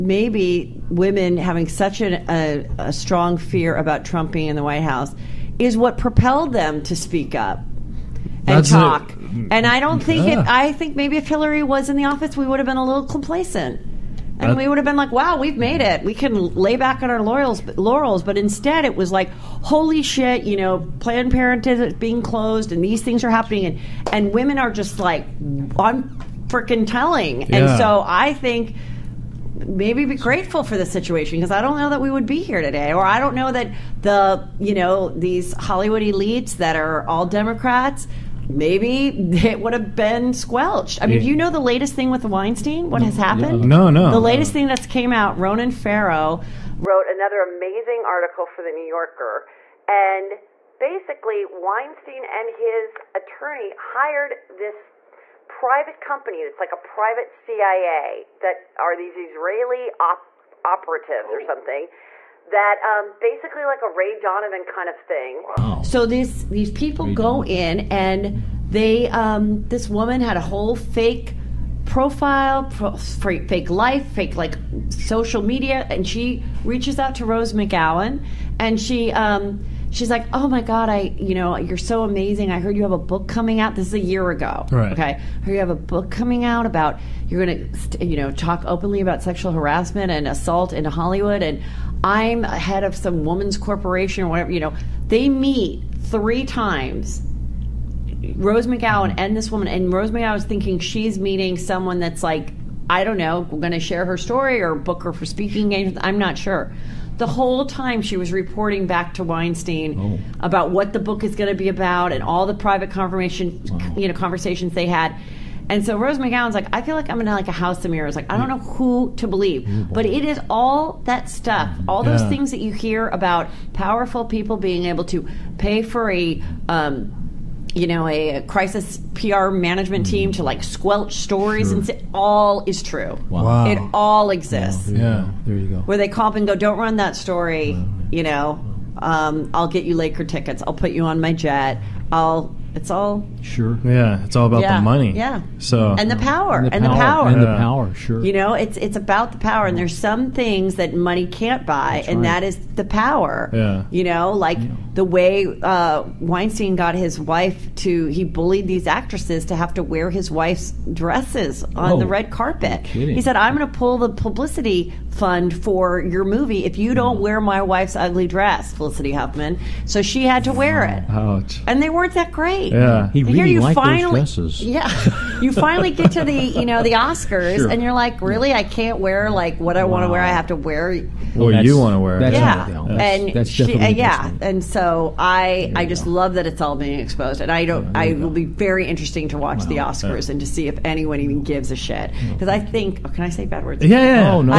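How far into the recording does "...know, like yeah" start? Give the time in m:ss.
2:34.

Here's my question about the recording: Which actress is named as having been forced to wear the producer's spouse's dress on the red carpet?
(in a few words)
Felicity Huffman.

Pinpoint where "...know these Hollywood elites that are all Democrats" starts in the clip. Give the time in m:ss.
0:34.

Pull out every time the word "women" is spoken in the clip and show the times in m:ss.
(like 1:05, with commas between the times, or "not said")
0:00, 0:24.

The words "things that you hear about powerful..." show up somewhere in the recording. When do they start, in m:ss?
2:02.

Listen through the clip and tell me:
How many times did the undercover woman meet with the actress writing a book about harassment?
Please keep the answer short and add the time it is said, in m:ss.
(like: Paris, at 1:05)
3, at 1:36.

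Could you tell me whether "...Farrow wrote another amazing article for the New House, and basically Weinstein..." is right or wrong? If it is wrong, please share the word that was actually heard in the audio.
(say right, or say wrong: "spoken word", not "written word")
wrong: "Yorker", not "House".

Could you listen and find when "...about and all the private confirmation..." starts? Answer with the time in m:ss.
1:51.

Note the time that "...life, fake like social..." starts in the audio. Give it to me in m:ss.
1:13.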